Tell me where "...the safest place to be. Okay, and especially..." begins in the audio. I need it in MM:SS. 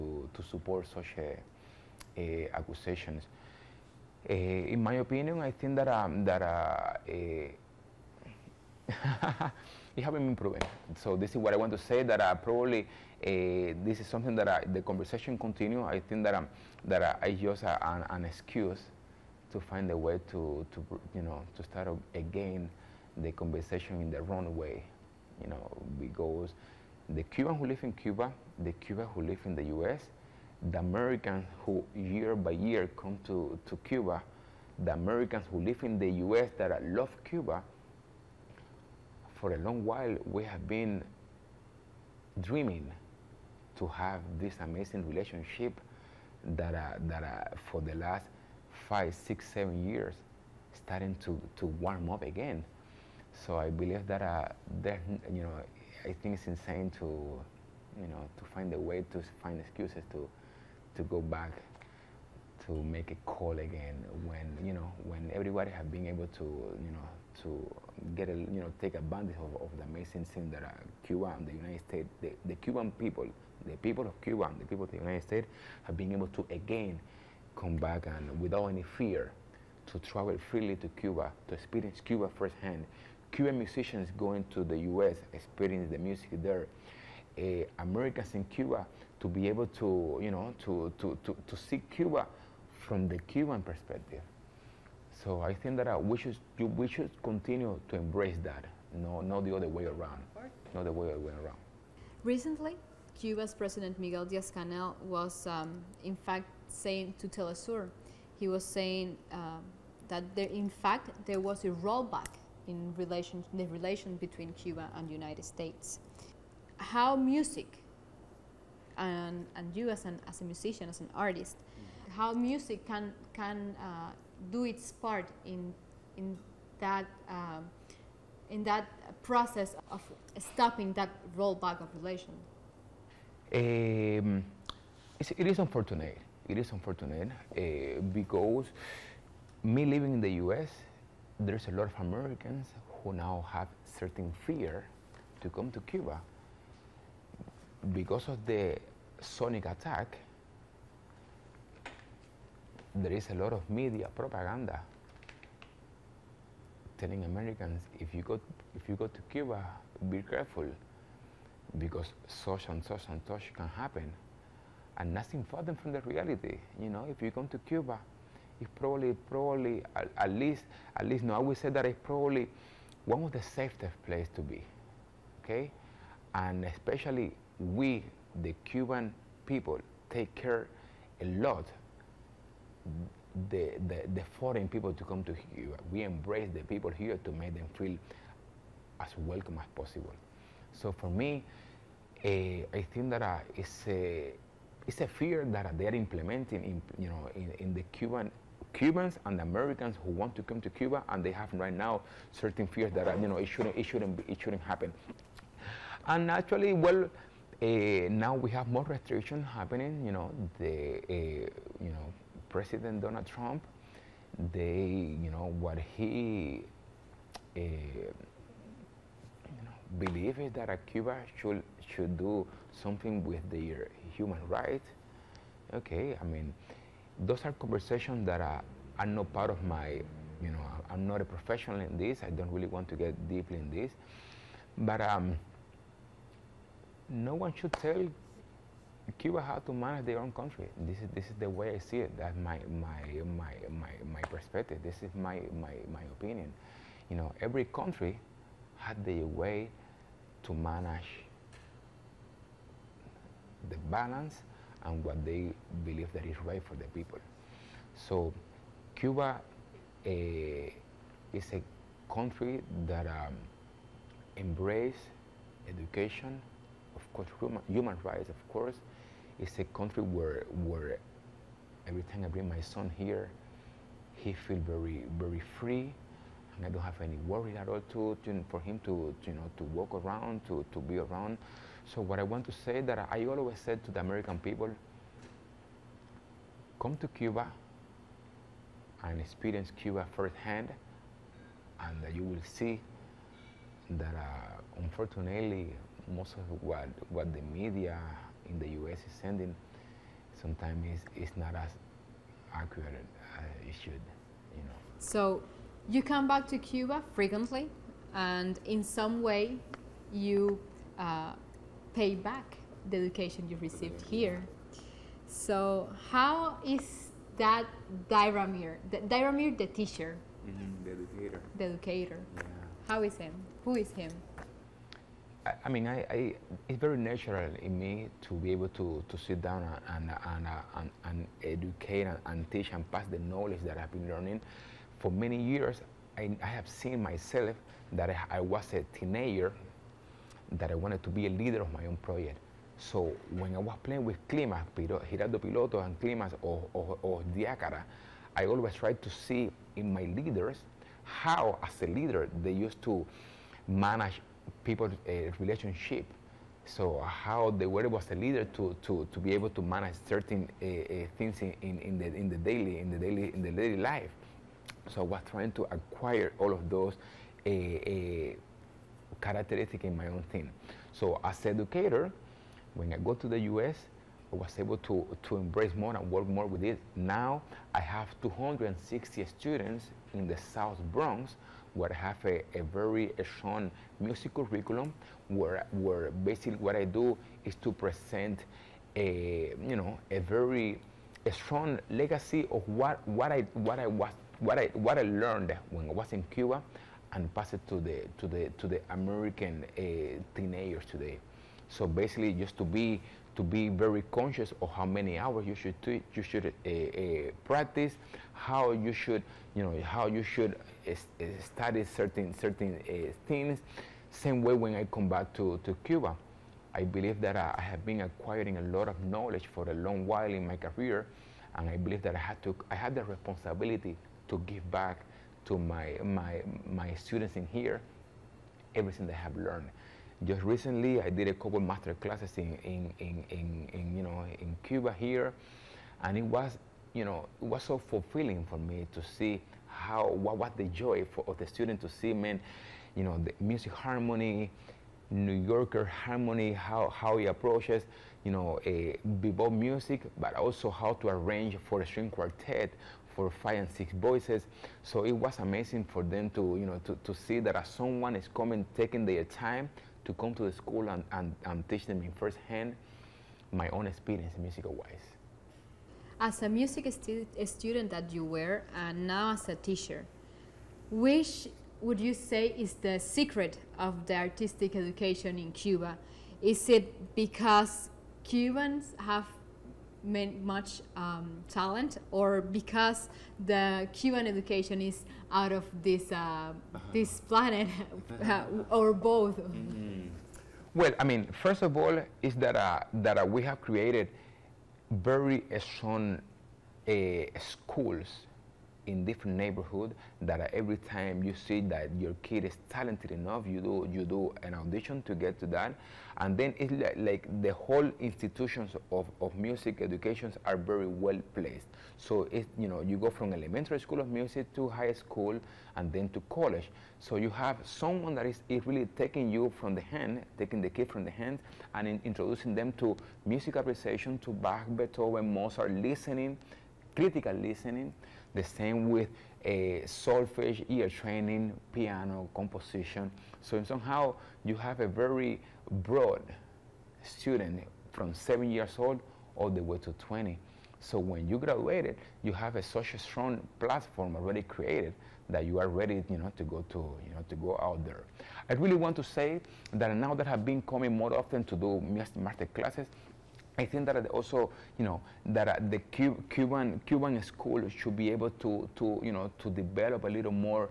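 02:53.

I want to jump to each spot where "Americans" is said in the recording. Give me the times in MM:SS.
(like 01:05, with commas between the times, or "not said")
00:30, 00:34, 01:27, 02:21, 02:37, 03:19, 04:43, 06:38.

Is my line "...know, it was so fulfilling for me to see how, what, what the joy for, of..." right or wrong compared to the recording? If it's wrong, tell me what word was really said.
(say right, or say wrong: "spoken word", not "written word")
right.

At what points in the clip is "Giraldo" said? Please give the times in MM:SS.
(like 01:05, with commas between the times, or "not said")
05:44.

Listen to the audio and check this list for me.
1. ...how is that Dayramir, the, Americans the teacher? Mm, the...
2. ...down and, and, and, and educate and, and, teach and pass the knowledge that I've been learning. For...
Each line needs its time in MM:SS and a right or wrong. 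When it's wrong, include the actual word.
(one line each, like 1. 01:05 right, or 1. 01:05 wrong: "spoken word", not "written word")
1. 05:16 wrong: "Dayramir", not "Americans"
2. 05:29 right.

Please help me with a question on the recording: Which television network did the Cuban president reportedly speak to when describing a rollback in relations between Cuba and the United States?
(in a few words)
Telesur.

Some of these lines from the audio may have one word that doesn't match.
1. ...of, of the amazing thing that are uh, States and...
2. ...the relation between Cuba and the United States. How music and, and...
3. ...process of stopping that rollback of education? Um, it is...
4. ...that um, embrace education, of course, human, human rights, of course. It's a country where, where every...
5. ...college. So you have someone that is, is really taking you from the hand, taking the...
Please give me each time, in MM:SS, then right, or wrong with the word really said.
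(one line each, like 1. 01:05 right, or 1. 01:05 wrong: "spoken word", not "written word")
1. 01:09 wrong: "Cuba", not "States"
2. 01:53 right
3. 02:09 wrong: "relation", not "education"
4. 04:22 right
5. 08:36 right.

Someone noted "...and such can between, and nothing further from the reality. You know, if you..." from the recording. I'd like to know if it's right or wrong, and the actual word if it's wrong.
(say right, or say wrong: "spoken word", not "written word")
wrong: "happen", not "between".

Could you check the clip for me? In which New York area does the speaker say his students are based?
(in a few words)
South Bronx.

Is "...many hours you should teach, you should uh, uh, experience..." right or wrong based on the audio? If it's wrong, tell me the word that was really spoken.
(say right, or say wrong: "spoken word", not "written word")
wrong: "practice", not "experience".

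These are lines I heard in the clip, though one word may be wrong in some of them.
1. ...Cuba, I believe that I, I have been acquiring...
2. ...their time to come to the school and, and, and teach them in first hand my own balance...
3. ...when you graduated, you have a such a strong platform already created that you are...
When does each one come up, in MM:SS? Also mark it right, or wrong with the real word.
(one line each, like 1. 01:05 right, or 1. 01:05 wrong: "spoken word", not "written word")
1. 06:55 right
2. 07:39 wrong: "experience", not "balance"
3. 09:00 right.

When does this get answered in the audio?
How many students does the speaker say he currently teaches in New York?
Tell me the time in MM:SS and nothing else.
06:18.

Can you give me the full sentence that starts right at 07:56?
Is it because Cubans have much um, talent or because the Cuban education is out of this, uh, uh-huh.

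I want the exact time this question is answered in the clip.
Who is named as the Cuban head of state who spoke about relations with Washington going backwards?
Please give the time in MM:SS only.
01:43.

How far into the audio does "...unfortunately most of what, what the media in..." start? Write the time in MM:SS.
04:54.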